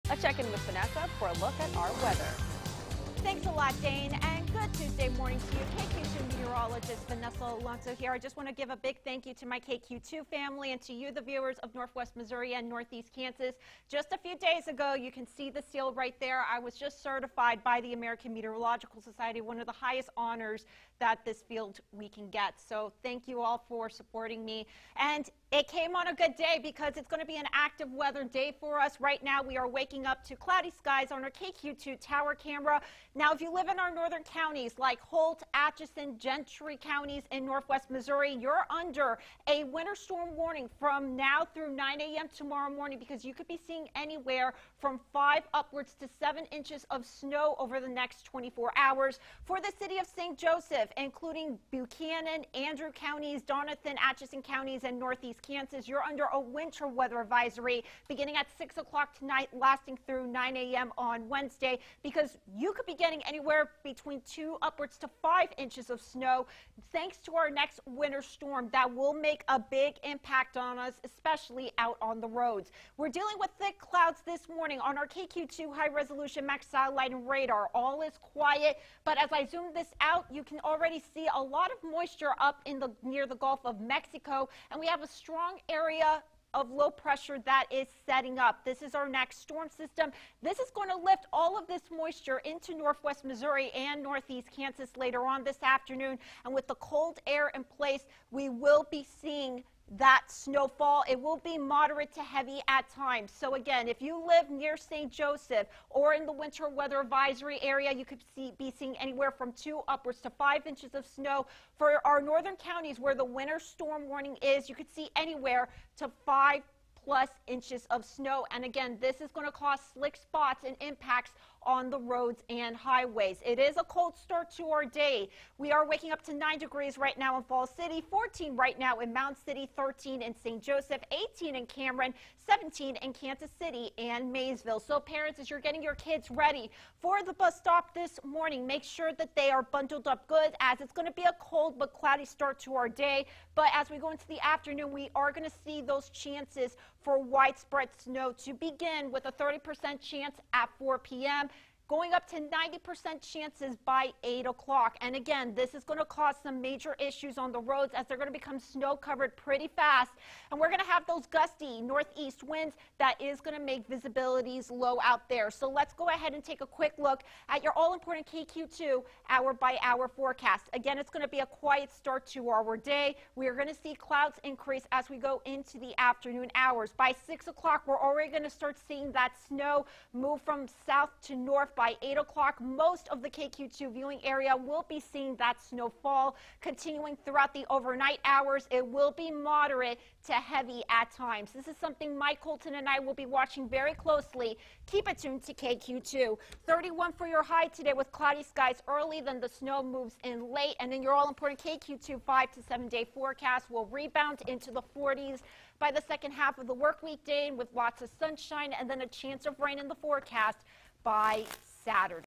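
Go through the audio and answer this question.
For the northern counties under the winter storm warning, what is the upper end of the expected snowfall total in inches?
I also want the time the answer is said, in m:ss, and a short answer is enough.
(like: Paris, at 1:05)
7, at 0:46.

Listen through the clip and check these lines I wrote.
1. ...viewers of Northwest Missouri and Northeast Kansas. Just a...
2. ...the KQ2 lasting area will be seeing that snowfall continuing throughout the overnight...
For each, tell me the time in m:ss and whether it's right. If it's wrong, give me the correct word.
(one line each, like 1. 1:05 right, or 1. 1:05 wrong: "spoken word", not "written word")
1. 0:11 right
2. 3:03 wrong: "viewing", not "lasting".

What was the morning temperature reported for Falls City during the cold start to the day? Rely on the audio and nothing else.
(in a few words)
9 degrees.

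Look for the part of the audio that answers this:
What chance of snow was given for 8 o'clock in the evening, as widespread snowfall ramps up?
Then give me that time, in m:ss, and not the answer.
2:32.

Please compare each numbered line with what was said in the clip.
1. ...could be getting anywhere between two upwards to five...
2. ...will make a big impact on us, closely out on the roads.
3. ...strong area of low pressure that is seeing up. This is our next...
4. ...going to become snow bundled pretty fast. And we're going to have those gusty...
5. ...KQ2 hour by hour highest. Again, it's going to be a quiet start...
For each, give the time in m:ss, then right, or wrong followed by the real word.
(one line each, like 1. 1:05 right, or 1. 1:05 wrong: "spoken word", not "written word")
1. 1:02 right
2. 1:08 wrong: "especially", not "closely"
3. 1:25 wrong: "setting", not "seeing"
4. 2:38 wrong: "covered", not "bundled"
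5. 2:48 wrong: "forecast", not "highest".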